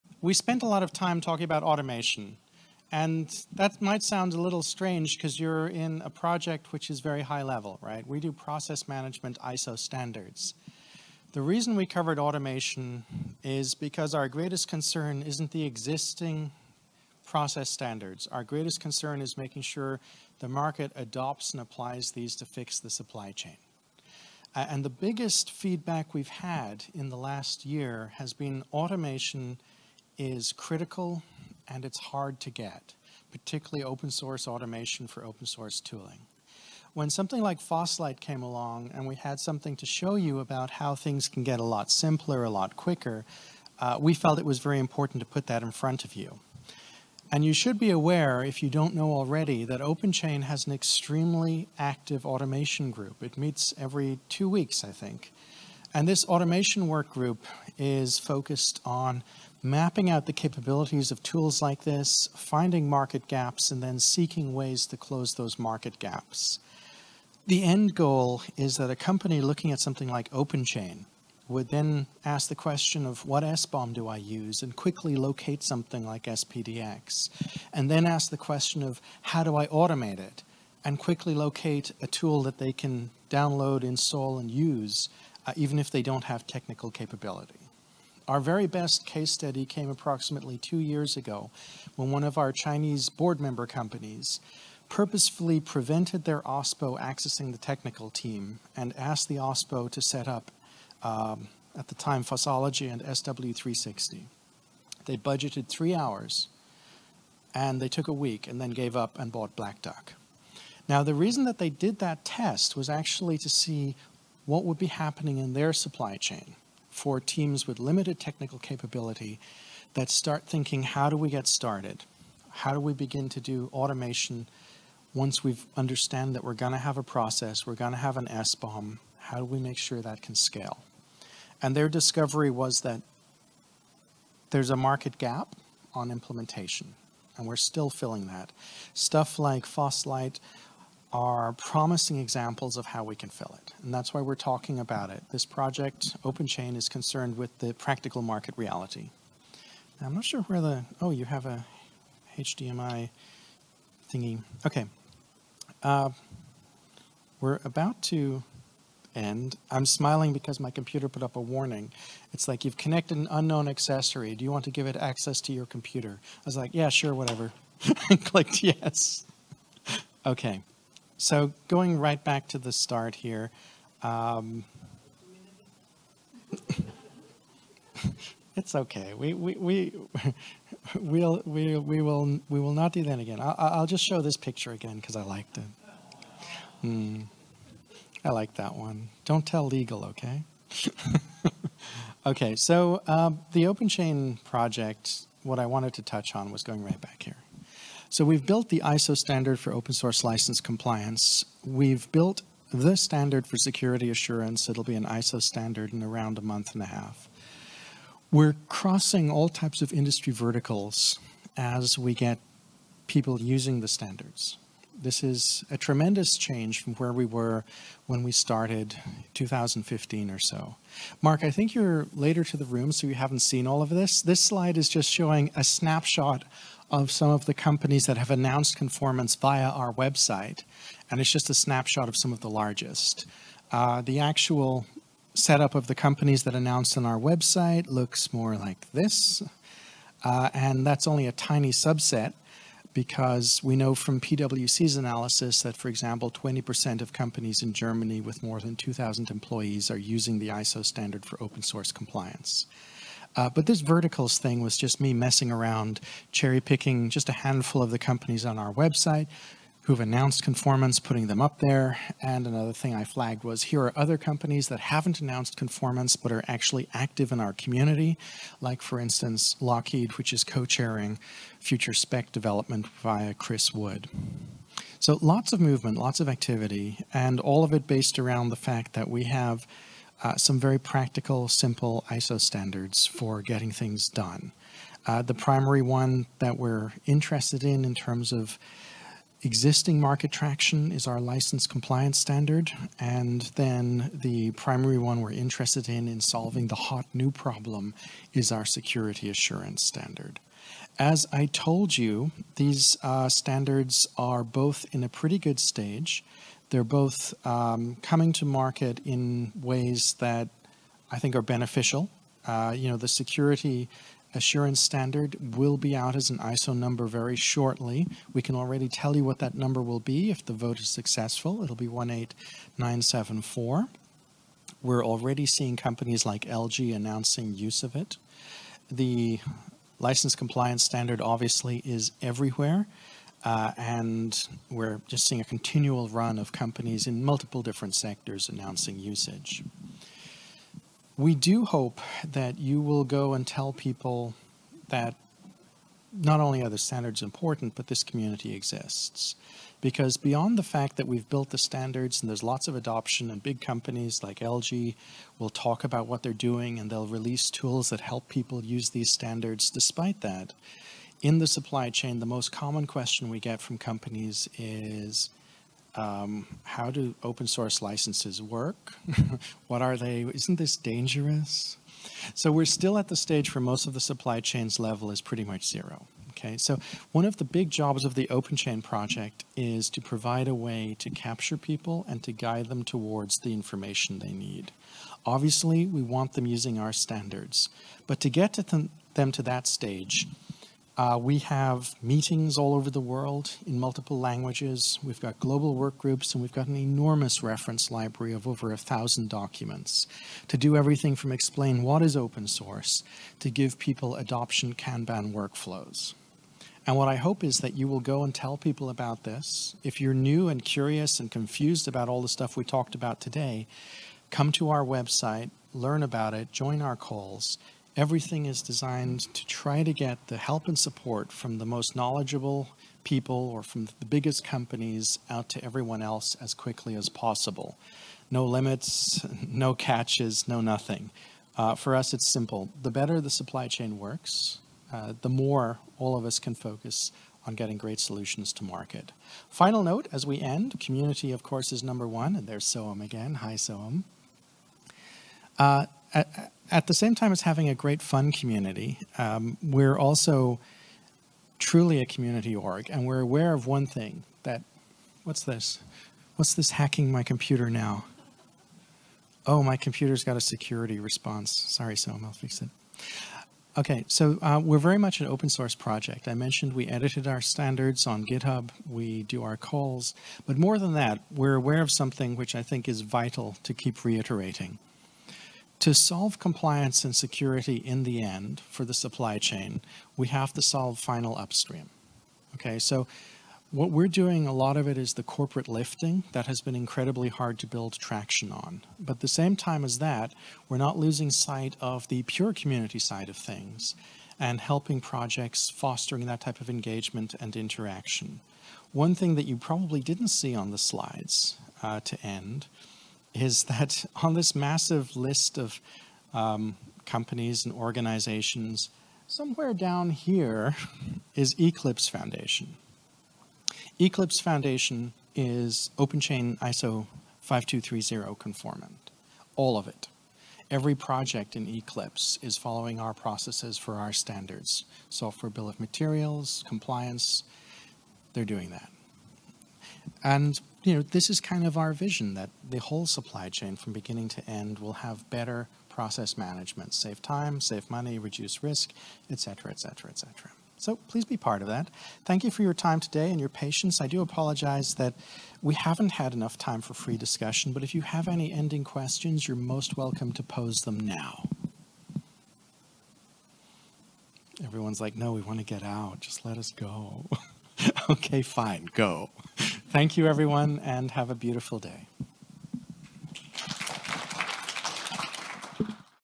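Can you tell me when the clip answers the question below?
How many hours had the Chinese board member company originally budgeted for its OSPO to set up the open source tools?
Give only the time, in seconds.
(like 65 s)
105 s.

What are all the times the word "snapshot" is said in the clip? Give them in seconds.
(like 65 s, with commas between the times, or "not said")
225 s, 231 s.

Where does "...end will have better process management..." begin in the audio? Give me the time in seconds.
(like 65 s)
534 s.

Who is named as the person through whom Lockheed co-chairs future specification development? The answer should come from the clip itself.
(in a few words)
Chris Wood.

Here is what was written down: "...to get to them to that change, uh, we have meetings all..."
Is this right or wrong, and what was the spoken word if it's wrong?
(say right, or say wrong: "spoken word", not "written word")
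wrong: "stage", not "change".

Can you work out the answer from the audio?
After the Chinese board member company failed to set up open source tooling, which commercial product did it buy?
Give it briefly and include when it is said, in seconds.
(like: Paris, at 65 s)
Black Duck, at 109 s.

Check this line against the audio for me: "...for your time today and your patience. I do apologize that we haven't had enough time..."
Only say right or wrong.
right.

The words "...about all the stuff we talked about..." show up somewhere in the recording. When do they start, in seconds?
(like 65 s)
411 s.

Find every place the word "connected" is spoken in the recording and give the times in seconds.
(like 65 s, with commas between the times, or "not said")
162 s.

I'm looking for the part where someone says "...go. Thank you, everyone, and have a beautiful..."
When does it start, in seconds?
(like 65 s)
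558 s.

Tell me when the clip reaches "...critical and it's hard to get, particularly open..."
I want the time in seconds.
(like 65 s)
30 s.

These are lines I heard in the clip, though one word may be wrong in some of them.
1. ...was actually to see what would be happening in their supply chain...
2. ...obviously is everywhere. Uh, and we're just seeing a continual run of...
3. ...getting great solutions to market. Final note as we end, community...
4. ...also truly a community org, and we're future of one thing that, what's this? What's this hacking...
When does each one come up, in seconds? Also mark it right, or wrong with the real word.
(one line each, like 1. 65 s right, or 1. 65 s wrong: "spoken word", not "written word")
1. 112 s right
2. 331 s right
3. 437 s right
4. 449 s wrong: "aware", not "future".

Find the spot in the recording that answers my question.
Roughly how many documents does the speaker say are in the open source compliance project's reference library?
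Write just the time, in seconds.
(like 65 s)
398 s.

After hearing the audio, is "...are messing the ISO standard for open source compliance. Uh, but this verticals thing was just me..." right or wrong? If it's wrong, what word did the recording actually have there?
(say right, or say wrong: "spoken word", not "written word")
wrong: "using", not "messing".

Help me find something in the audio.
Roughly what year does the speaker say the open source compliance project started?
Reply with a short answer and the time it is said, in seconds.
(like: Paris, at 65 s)
2015, at 219 s.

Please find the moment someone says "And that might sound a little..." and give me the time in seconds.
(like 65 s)
2 s.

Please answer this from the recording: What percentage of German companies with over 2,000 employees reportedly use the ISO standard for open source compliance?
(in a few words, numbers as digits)
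20%.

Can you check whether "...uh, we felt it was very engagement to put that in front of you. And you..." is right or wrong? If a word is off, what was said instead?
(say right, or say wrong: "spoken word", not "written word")
wrong: "important", not "engagement".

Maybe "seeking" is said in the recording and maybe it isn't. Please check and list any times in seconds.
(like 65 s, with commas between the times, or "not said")
63 s.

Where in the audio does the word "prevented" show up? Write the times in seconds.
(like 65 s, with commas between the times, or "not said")
95 s.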